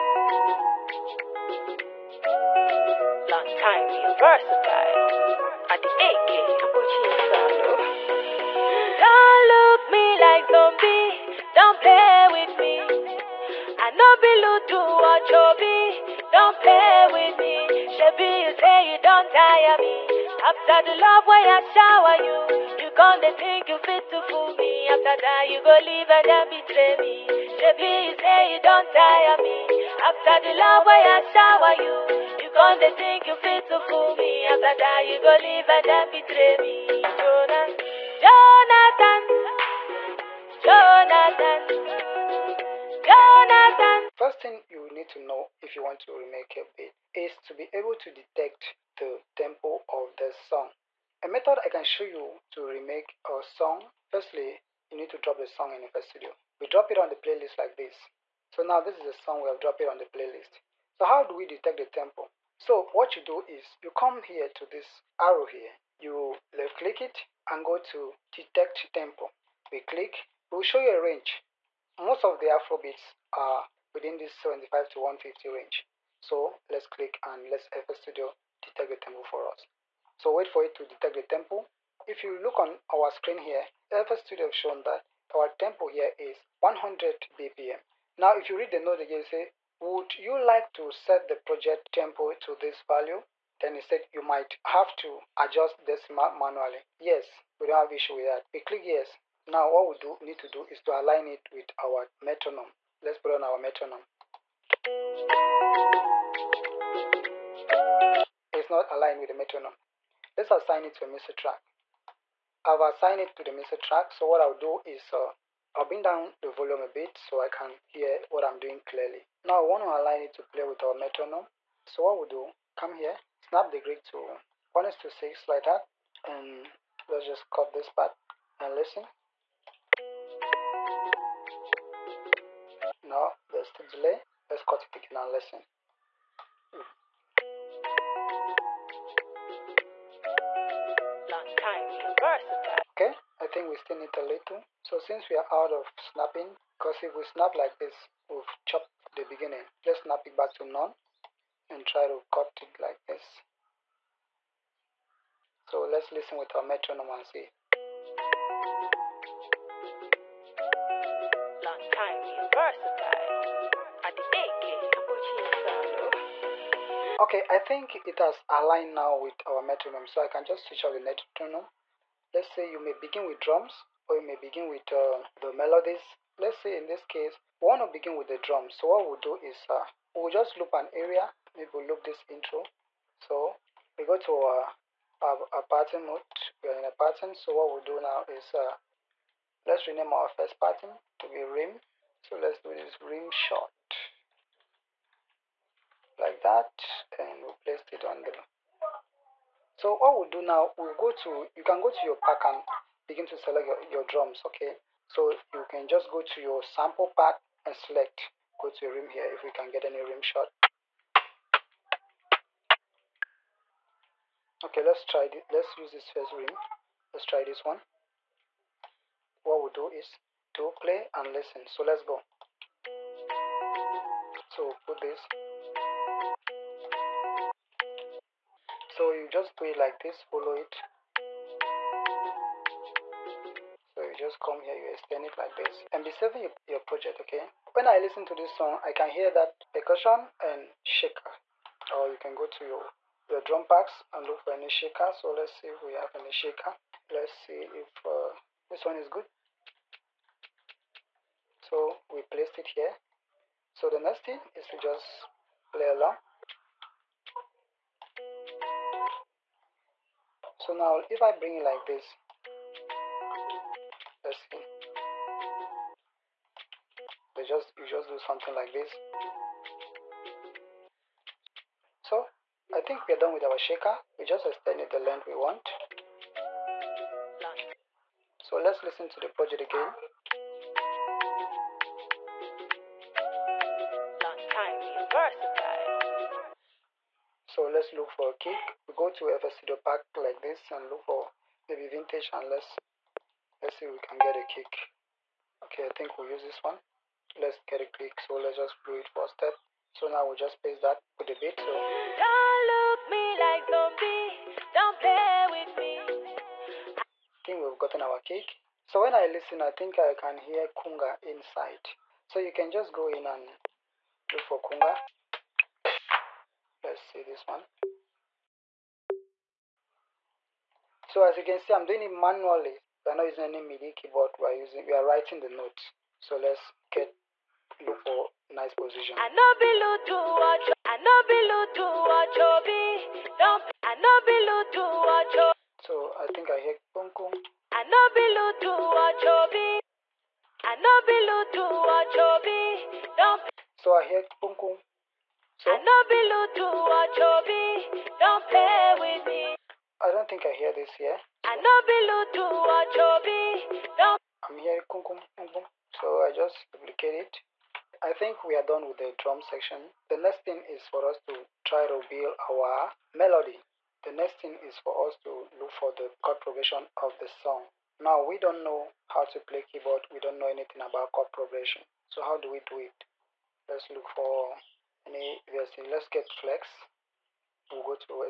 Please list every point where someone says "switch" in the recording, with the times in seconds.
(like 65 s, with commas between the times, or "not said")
170 s.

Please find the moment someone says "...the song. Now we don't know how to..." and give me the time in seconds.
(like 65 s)
367 s.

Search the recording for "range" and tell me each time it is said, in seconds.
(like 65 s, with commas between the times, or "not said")
71 s, 75 s.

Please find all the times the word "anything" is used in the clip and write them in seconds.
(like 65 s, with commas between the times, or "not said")
370 s.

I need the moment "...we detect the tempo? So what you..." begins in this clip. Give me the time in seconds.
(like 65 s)
61 s.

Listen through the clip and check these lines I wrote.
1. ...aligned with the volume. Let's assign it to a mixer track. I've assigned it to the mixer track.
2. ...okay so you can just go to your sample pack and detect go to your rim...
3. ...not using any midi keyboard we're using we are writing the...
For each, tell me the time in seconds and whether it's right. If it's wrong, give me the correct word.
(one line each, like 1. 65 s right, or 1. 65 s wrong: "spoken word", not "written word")
1. 108 s wrong: "metronome", not "volume"
2. 204 s wrong: "select", not "detect"
3. 323 s right.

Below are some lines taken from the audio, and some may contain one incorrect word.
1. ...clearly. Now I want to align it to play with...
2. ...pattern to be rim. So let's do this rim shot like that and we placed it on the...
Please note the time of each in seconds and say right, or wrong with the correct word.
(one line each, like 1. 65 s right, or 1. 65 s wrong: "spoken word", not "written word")
1. 118 s right
2. 190 s right.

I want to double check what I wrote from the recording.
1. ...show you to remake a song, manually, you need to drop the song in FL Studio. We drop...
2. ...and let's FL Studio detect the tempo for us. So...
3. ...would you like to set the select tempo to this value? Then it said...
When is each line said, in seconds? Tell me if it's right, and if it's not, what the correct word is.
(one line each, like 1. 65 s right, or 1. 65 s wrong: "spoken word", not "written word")
1. 51 s wrong: "firstly", not "manually"
2. 77 s right
3. 89 s wrong: "project", not "select".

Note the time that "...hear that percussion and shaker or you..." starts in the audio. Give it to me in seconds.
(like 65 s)
239 s.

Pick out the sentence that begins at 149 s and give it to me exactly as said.
Let's snap it back to none and try to cut it like this.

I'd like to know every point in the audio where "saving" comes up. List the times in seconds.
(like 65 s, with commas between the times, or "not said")
236 s.